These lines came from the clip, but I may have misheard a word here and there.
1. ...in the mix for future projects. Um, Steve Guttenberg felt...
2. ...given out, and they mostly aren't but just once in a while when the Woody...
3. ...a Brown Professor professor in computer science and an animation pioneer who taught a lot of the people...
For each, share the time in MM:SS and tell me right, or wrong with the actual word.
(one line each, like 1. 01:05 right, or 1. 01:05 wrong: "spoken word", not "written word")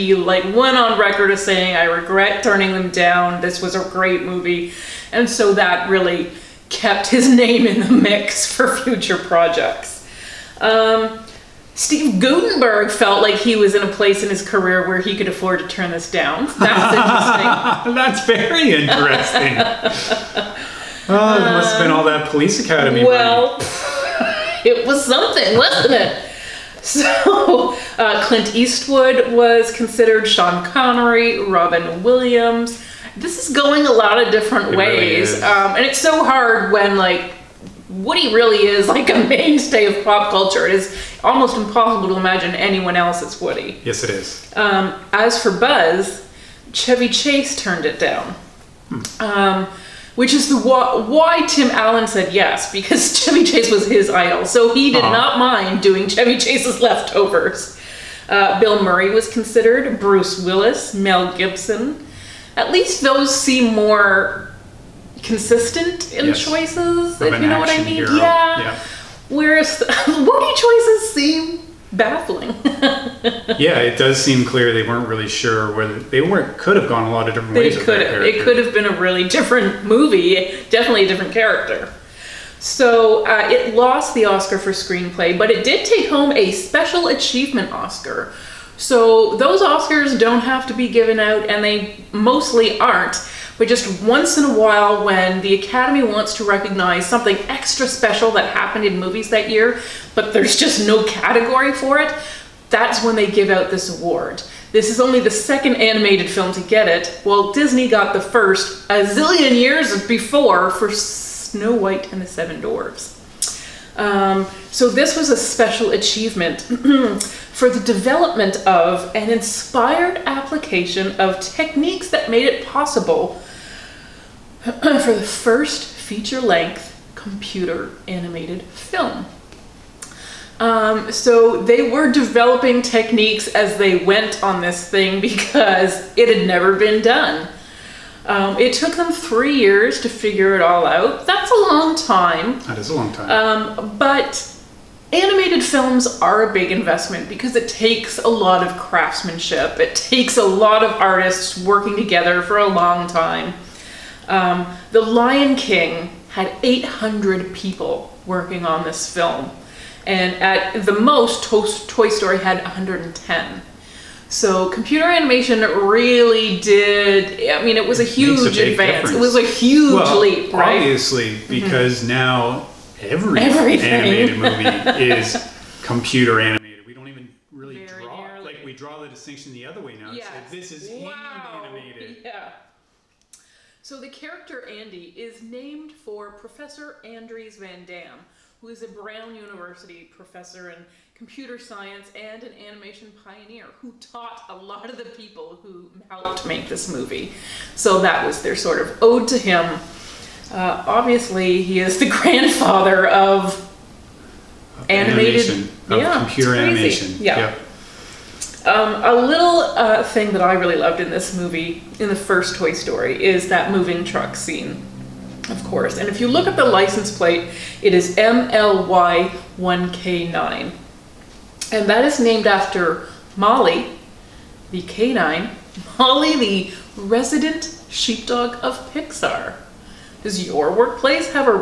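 1. 00:07 right
2. 01:30 wrong: "Academy", not "Woody"
3. 03:08 wrong: "University", not "Professor".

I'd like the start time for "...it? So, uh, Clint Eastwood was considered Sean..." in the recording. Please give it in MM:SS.
00:25.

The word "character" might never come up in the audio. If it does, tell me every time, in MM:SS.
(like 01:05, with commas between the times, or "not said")
01:21, 03:04.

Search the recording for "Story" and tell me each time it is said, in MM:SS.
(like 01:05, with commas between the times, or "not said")
02:42, 03:32.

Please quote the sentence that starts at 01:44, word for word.
This is only the second animated film to get it.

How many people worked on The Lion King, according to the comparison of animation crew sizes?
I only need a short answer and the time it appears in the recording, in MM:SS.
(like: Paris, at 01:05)
800, at 02:36.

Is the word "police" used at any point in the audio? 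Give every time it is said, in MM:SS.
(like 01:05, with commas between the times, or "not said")
00:22.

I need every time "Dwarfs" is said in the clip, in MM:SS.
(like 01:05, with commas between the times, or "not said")
01:52.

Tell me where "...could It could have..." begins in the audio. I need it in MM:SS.
01:17.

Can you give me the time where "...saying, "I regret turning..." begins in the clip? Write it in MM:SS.
00:01.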